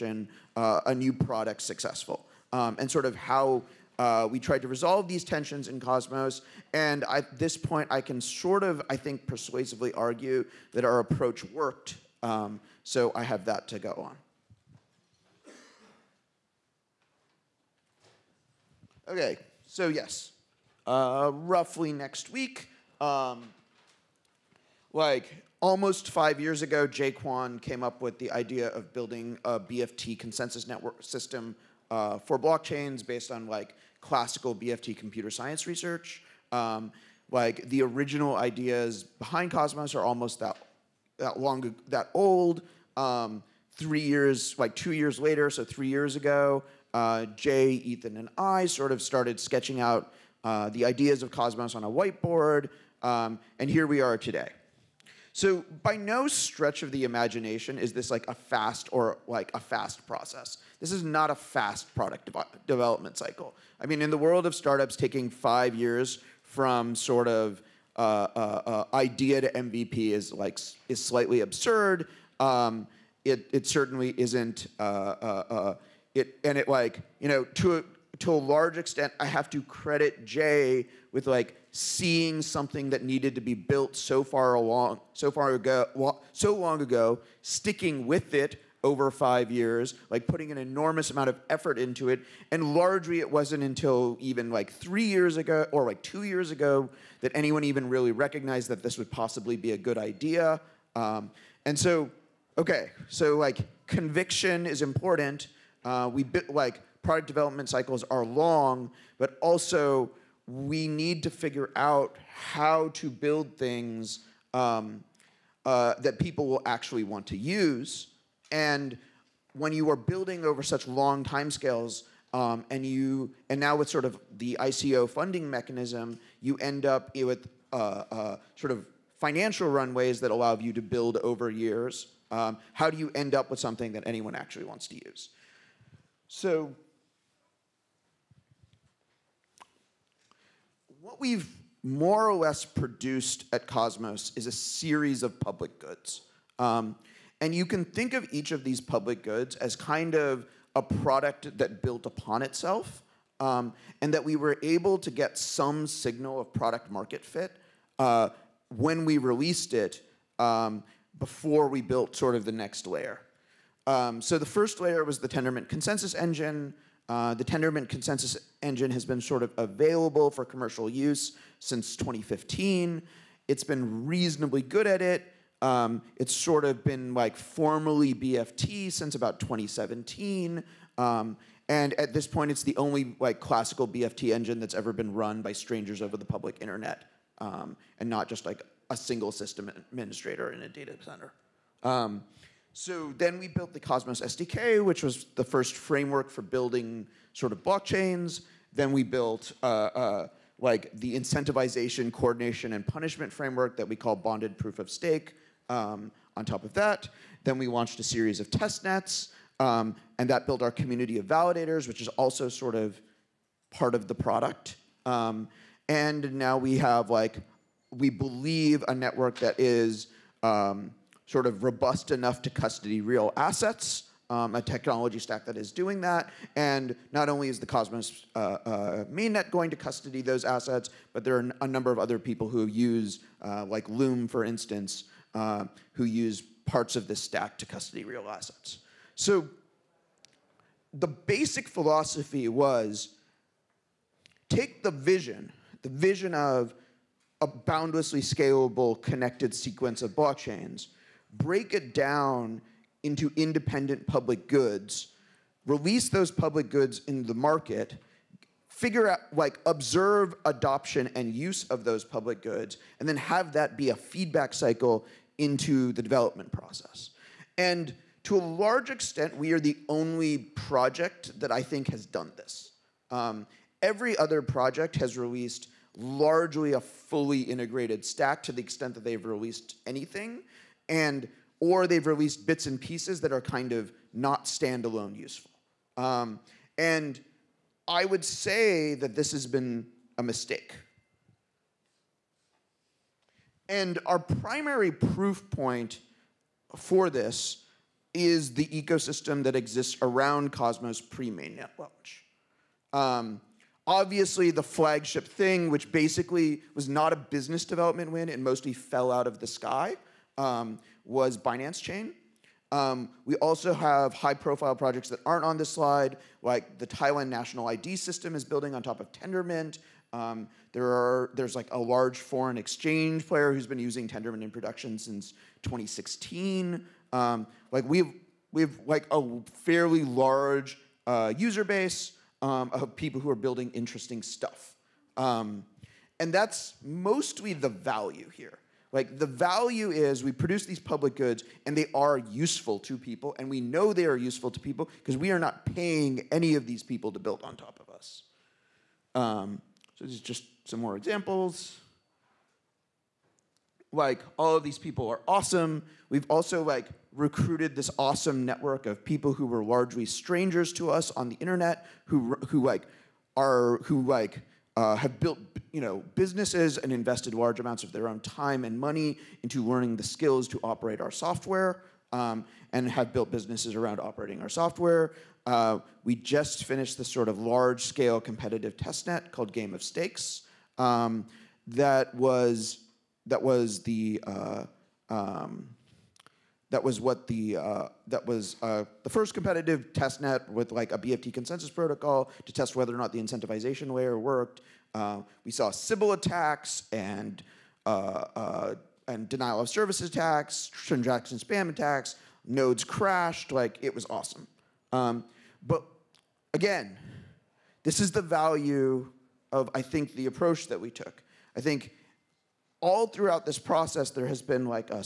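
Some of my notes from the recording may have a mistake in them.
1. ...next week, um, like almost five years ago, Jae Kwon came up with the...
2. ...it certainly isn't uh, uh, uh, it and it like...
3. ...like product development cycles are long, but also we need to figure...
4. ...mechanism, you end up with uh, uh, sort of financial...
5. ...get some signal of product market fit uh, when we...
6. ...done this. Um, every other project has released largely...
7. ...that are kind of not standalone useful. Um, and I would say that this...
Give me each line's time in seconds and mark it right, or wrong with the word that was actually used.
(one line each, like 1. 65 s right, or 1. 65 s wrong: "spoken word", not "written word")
1. 21 s right
2. 73 s right
3. 106 s right
4. 125 s right
5. 155 s right
6. 272 s right
7. 283 s right.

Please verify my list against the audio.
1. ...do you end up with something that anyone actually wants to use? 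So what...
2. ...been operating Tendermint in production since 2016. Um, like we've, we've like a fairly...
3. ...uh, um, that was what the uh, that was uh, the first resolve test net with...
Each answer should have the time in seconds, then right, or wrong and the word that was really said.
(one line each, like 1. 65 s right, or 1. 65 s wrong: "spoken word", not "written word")
1. 132 s right
2. 323 s wrong: "using", not "operating"
3. 384 s wrong: "competitive", not "resolve".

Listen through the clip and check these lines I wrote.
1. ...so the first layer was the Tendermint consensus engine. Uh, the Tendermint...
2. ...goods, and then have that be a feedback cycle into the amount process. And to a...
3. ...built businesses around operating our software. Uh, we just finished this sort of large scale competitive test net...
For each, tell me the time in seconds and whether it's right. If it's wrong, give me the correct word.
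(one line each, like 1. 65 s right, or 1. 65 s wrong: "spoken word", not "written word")
1. 164 s right
2. 262 s wrong: "development", not "amount"
3. 373 s right.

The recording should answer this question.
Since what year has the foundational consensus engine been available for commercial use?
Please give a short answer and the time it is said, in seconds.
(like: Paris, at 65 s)
2015, at 171 s.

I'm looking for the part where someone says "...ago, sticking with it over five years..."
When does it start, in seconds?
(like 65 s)
86 s.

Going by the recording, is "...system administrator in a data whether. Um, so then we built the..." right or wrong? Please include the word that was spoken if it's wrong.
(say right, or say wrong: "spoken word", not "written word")
wrong: "center", not "whether".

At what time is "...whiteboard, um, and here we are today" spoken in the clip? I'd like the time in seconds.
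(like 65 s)
51 s.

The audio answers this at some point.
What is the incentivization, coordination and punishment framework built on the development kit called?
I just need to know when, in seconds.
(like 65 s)
204 s.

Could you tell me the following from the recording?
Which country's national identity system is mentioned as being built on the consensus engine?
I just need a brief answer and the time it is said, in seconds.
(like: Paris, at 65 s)
Thailand, at 316 s.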